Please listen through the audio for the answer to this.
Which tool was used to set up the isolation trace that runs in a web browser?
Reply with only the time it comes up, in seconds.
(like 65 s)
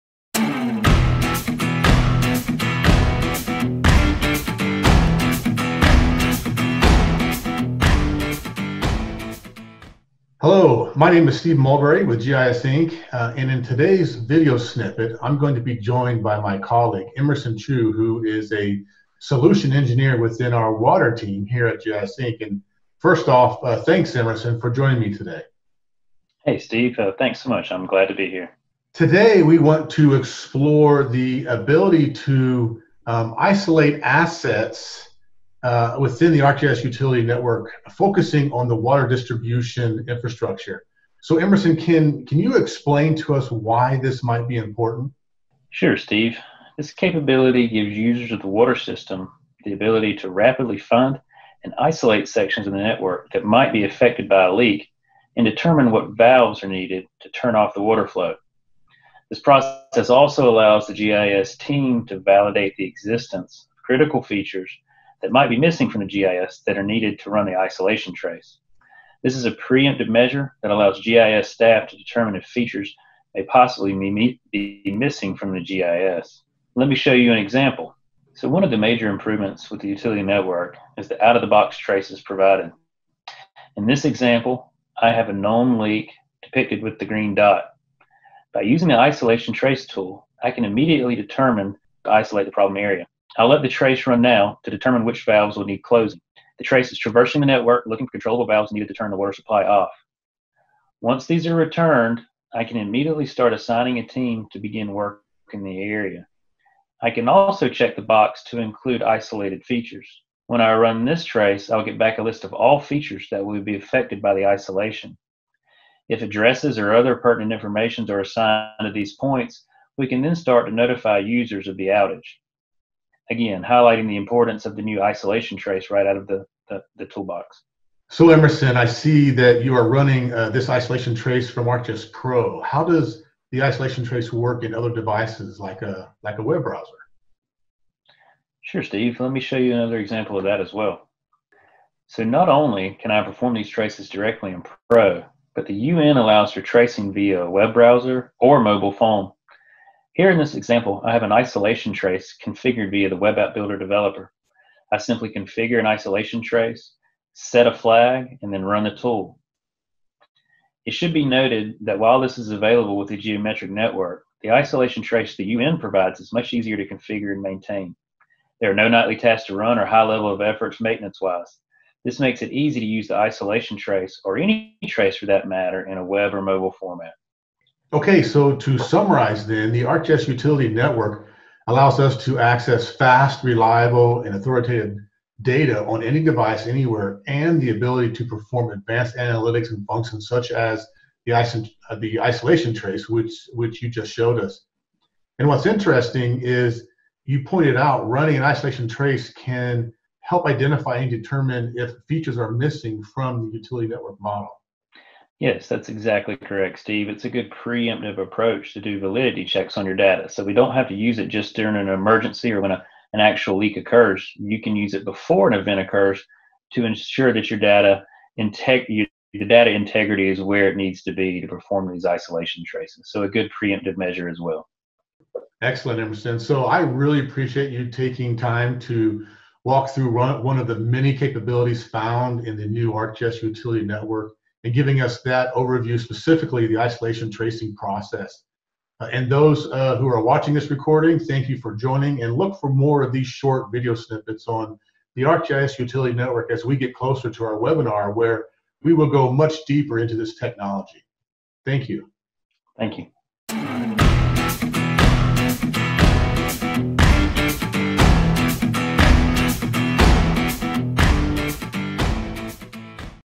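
153 s.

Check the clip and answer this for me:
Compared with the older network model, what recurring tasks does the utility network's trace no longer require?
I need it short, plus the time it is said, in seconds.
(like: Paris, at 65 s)
Nightly tasks, at 168 s.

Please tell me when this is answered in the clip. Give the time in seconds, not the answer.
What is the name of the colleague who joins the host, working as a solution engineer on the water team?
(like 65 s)
17 s.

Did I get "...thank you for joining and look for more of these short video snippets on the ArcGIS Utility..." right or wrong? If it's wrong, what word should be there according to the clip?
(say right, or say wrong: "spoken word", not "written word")
right.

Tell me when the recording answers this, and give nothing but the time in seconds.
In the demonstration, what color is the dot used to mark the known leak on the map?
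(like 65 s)
87 s.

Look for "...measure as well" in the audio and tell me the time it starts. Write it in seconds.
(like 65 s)
223 s.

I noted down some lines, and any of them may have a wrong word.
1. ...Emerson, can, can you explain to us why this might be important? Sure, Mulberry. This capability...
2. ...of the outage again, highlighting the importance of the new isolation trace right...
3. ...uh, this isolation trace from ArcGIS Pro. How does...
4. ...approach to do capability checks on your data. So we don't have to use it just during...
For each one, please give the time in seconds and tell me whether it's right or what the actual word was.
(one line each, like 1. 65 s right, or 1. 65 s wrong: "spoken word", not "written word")
1. 41 s wrong: "Steve", not "Mulberry"
2. 121 s right
3. 130 s right
4. 208 s wrong: "validity", not "capability".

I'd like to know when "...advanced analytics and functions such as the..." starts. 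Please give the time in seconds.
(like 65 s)
188 s.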